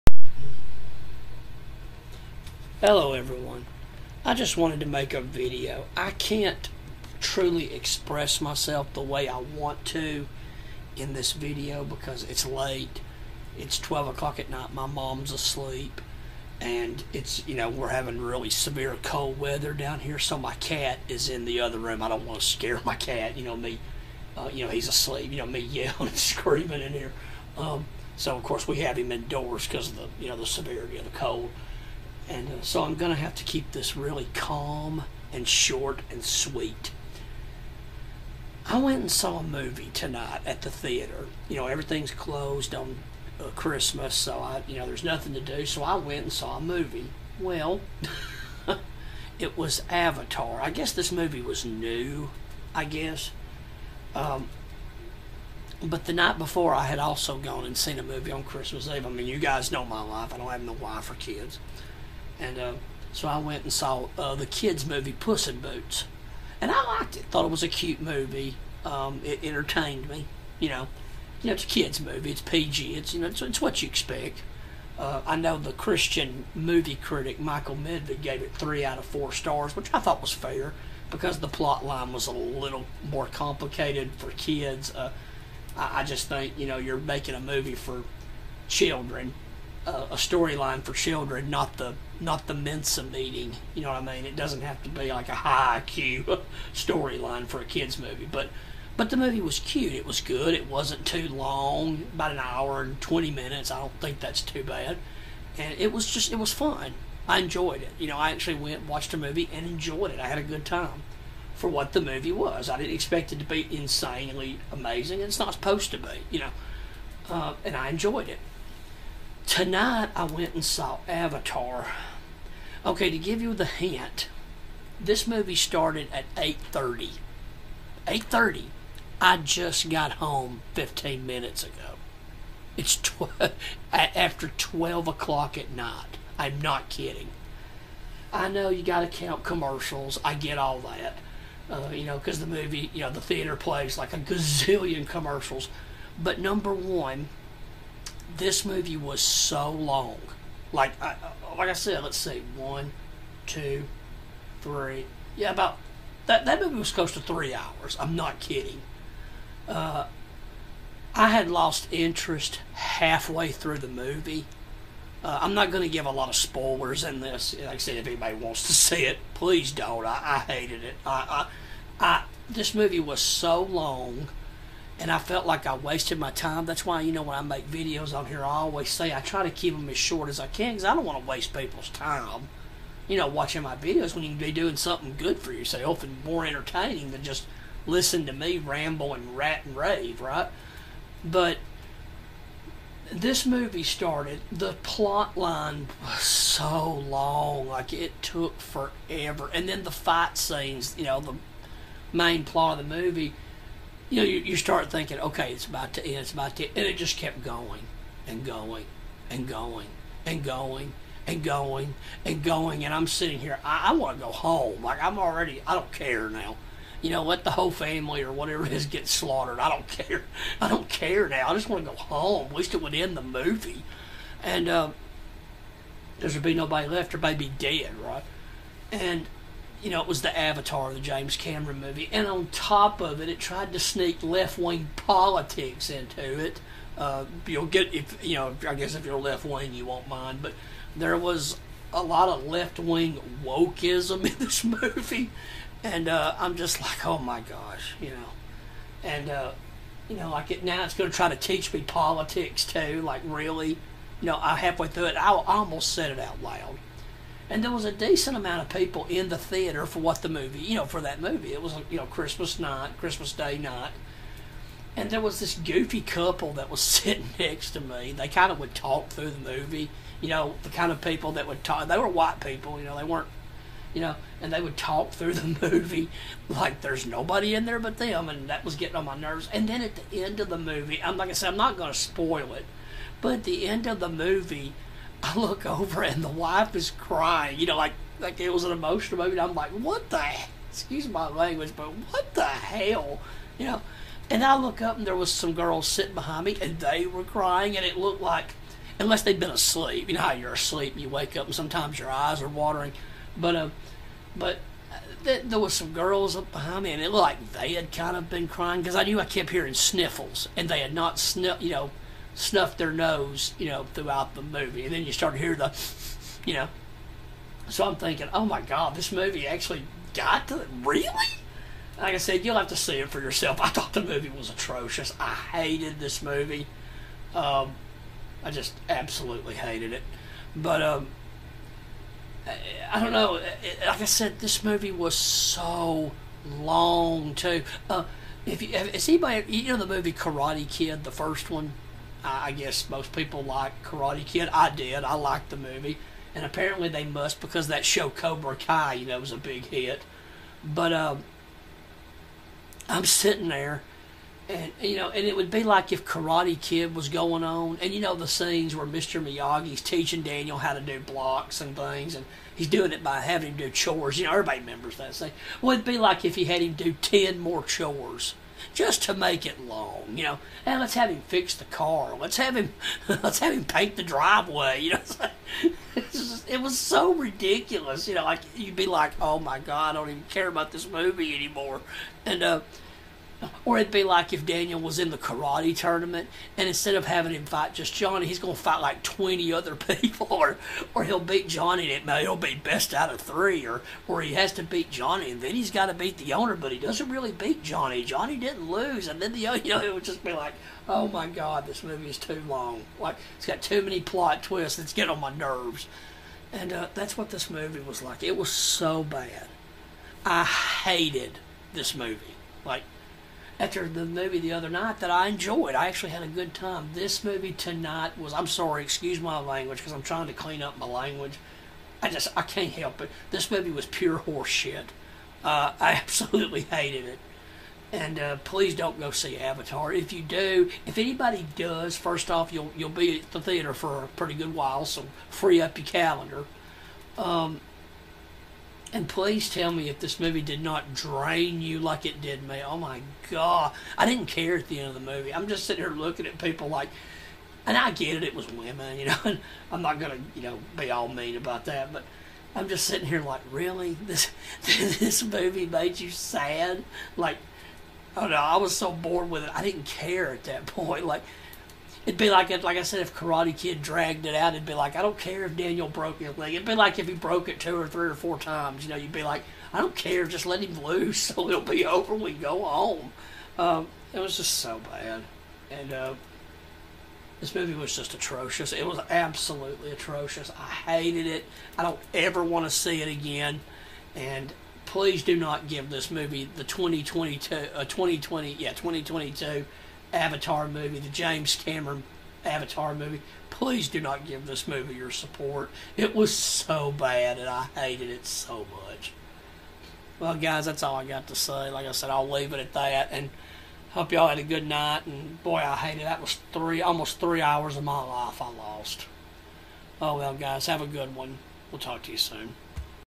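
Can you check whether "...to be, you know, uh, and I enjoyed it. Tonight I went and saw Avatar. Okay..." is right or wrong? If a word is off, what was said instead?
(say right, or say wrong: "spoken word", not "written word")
right.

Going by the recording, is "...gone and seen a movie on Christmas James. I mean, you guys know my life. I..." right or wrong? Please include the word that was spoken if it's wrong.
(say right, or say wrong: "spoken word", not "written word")
wrong: "Eve", not "James".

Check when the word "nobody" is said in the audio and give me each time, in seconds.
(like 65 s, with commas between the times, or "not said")
226 s, 277 s.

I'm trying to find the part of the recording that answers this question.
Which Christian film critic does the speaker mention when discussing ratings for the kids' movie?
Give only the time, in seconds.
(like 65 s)
77 s.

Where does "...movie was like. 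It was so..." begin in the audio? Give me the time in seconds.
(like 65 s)
407 s.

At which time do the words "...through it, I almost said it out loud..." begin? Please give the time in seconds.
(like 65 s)
254 s.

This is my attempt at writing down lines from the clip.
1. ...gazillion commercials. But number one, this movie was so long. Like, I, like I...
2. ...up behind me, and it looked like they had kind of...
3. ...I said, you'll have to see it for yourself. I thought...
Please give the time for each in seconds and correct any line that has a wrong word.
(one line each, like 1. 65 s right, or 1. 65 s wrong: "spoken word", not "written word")
1. 144 s right
2. 306 s right
3. 322 s right.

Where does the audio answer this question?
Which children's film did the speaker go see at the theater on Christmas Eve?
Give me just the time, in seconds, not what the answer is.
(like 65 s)
65 s.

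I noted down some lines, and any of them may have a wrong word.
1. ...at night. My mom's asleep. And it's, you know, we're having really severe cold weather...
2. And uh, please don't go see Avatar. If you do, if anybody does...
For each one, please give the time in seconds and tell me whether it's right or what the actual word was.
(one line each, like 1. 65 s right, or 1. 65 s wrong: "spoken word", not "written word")
1. 14 s right
2. 427 s right.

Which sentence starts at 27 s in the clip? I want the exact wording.
Um, so, of course, we have him indoors because of the, you know, the severity of the cold.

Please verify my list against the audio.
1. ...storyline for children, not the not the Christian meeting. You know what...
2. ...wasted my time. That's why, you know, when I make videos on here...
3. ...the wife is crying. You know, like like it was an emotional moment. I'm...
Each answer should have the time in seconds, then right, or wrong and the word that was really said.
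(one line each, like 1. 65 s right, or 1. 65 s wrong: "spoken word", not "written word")
1. 90 s wrong: "Mensa", not "Christian"
2. 175 s right
3. 286 s right.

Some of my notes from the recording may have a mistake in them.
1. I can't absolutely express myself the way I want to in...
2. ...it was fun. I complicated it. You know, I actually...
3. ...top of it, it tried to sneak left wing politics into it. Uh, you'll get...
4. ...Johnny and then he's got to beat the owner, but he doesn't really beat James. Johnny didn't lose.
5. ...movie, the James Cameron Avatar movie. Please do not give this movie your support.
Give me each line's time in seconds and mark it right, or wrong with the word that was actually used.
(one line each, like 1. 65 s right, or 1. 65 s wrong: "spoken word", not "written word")
1. 5 s wrong: "truly", not "absolutely"
2. 106 s wrong: "enjoyed", not "complicated"
3. 232 s right
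4. 394 s wrong: "Johnny", not "James"
5. 490 s right.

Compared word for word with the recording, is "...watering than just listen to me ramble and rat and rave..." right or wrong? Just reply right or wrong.
wrong.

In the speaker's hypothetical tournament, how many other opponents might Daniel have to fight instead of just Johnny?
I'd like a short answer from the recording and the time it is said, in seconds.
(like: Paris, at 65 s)
20, at 389 s.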